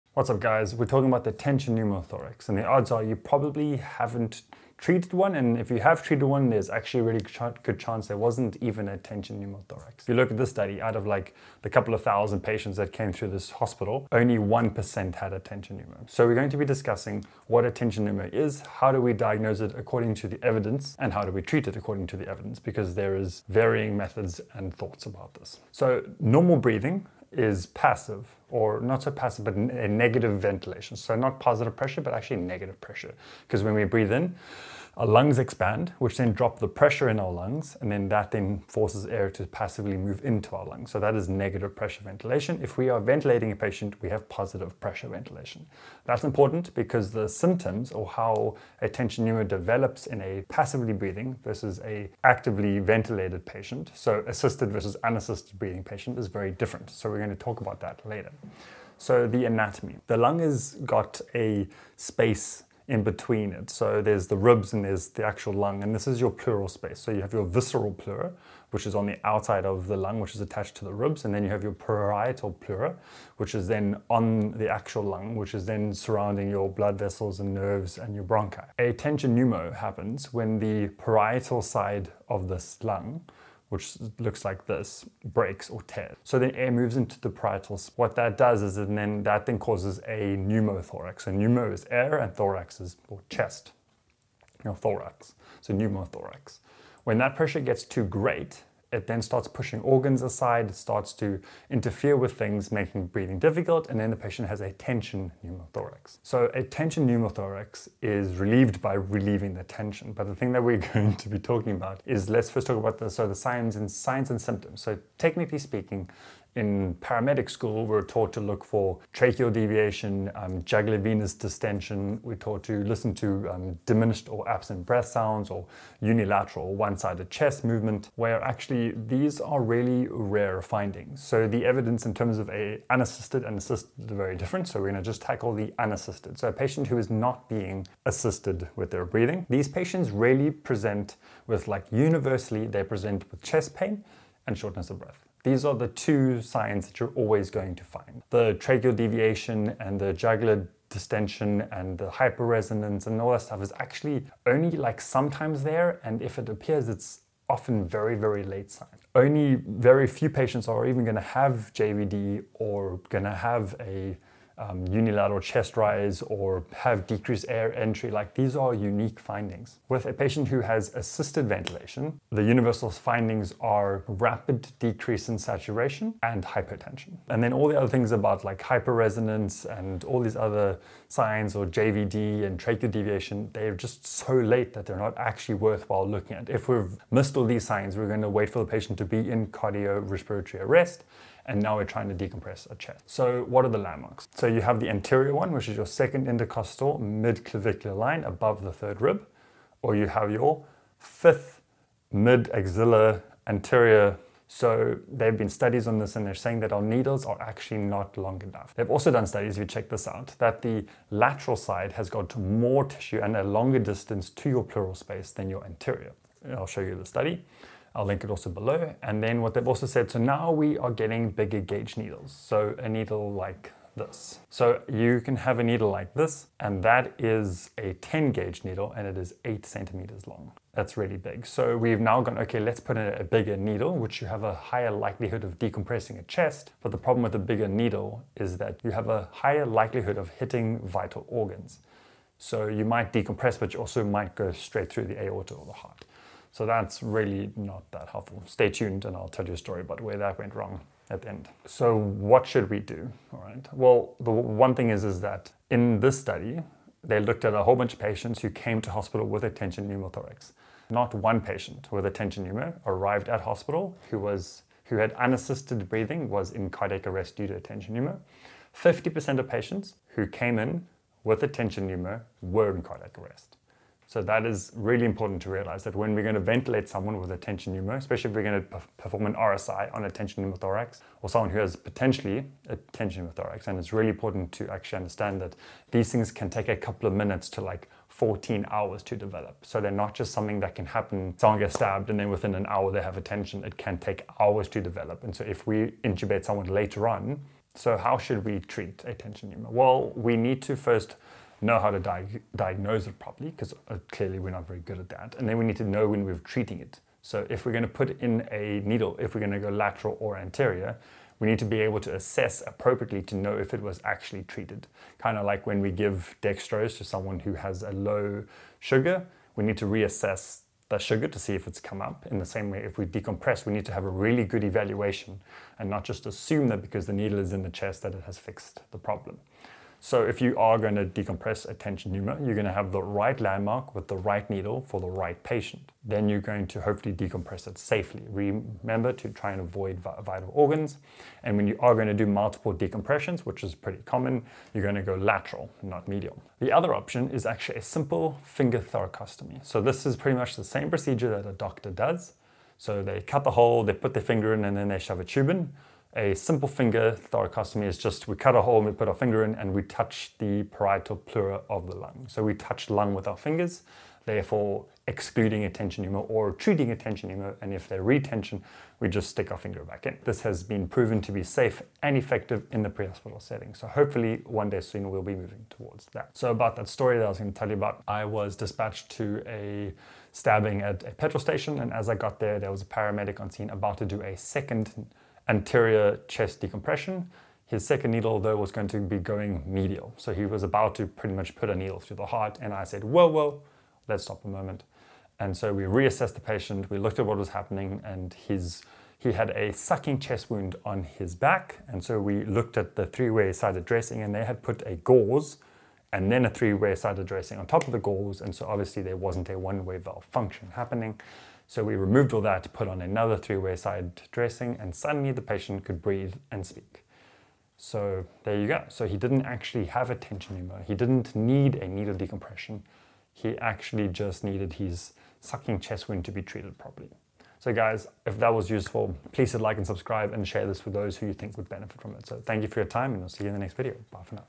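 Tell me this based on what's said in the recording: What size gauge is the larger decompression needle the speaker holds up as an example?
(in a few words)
10 gauge.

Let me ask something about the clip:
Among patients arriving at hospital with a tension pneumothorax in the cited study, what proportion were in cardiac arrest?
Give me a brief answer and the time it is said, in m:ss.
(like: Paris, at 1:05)
50%, at 4:28.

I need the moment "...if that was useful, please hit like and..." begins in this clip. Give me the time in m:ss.
7:08.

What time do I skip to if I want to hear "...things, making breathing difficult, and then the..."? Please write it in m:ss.
1:42.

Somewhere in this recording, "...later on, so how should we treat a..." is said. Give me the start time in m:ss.
4:56.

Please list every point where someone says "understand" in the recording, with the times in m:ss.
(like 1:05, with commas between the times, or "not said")
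4:44.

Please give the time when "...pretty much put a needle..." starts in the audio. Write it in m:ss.
6:31.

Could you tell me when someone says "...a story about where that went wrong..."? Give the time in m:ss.
4:09.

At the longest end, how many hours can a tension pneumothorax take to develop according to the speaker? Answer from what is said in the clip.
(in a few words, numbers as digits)
14 hours.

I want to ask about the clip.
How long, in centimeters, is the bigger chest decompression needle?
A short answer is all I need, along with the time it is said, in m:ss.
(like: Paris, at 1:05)
8 centimeters, at 3:49.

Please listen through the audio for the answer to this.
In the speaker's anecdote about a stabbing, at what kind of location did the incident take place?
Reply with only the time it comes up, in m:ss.
6:21.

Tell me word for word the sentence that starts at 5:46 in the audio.
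The other option is actually a simple finger thoracostomy.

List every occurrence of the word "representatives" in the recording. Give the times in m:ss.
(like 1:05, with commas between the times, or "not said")
not said.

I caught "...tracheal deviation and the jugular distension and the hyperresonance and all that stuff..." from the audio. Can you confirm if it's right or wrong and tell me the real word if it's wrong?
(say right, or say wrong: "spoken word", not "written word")
right.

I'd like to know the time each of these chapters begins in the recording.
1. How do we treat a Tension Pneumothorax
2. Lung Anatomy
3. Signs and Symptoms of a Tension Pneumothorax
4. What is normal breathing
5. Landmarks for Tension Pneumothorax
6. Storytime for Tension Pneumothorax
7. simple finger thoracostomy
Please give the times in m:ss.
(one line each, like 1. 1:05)
1. 4:10
2. 0:58
3. 1:50
4. 0:25
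5. 3:13
6. 6:16
7. 5:43.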